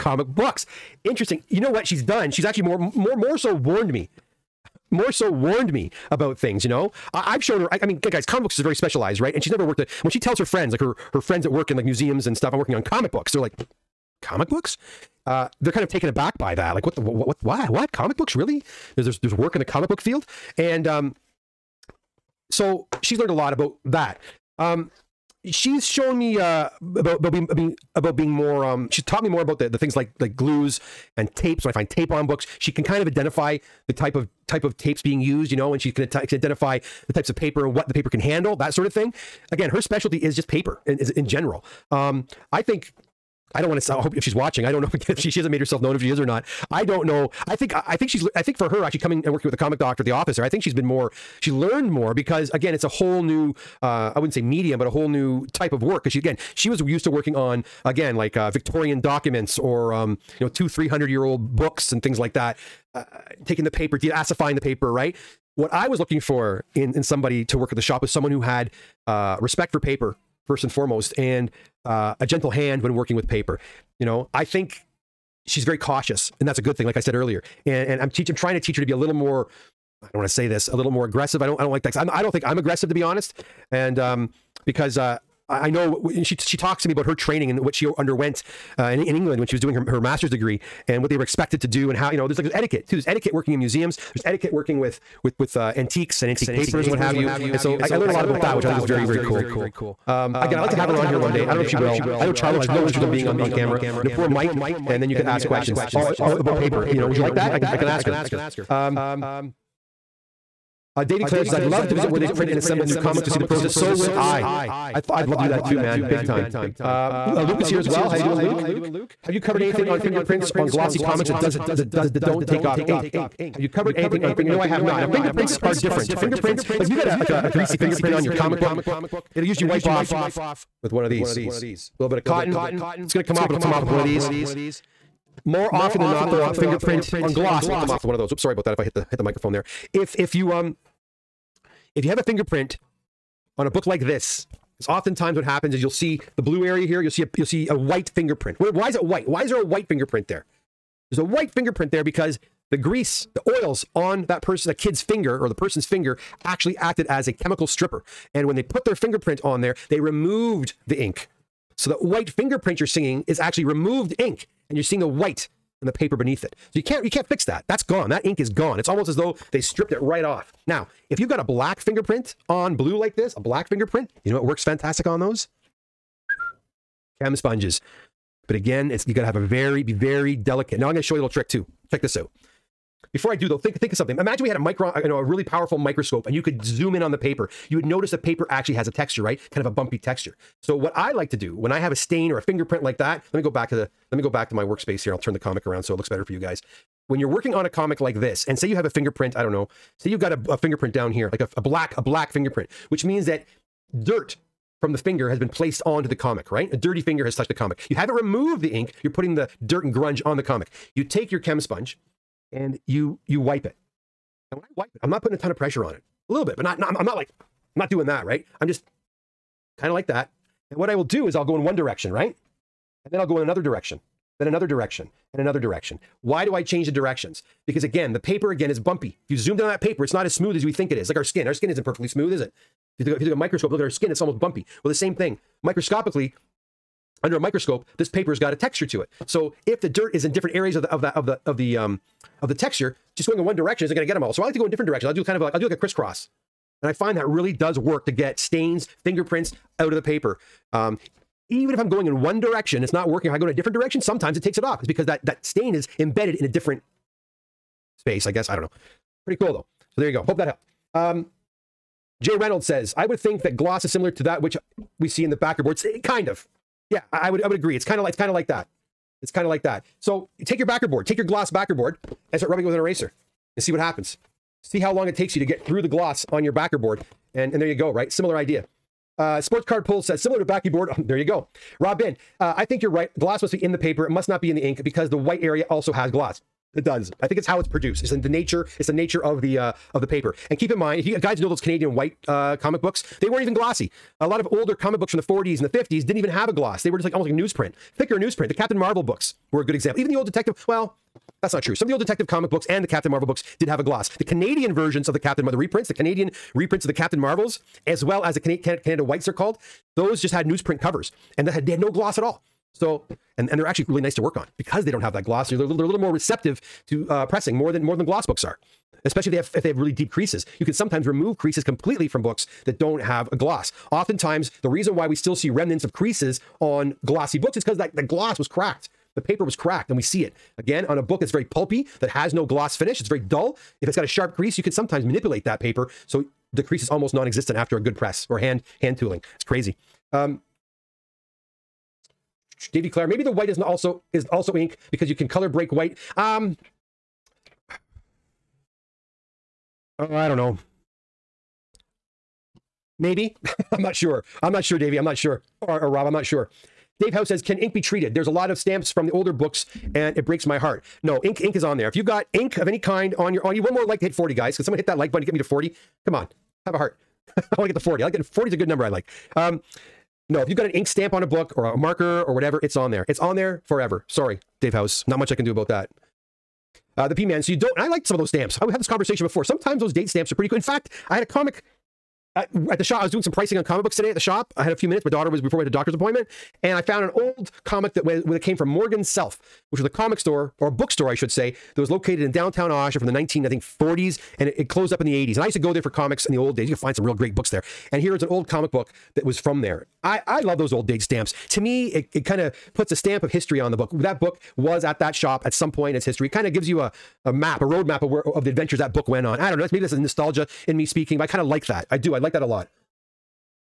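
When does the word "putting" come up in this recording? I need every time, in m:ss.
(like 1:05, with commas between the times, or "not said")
3:29, 3:35.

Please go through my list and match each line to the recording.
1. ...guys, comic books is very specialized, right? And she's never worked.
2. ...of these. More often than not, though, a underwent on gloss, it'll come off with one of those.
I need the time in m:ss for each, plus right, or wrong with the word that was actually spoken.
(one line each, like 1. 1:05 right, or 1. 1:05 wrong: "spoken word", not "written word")
1. 0:07 right
2. 2:13 wrong: "fingerprint", not "underwent".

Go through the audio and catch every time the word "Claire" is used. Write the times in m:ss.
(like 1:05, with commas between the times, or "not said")
5:42.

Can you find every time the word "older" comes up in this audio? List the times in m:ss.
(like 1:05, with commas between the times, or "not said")
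4:54, 5:59.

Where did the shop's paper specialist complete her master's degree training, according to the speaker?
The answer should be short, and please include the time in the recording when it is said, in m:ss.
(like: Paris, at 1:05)
England, at 1:29.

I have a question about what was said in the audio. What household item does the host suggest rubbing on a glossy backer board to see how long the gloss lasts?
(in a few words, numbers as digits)
An eraser.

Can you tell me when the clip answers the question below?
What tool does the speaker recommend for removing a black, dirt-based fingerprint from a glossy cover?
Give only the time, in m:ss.
2:57.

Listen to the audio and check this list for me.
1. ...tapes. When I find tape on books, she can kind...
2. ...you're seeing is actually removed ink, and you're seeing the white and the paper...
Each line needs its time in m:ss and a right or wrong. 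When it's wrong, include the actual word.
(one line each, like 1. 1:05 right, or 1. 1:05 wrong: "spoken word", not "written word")
1. 0:31 right
2. 2:42 right.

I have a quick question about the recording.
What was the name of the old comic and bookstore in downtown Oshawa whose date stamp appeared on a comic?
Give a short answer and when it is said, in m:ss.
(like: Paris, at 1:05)
Morgan Self, at 6:28.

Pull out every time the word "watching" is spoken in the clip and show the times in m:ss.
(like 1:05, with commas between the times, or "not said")
0:44.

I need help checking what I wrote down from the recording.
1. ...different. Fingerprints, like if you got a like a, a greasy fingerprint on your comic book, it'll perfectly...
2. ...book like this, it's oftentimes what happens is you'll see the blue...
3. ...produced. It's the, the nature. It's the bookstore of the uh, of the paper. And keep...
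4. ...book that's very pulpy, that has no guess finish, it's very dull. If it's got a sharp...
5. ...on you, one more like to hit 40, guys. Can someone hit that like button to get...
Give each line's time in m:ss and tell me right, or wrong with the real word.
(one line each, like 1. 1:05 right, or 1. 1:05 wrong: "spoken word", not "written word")
1. 2:05 wrong: "usually", not "perfectly"
2. 2:23 right
3. 4:47 wrong: "nature", not "bookstore"
4. 5:31 wrong: "gloss", not "guess"
5. 6:03 right.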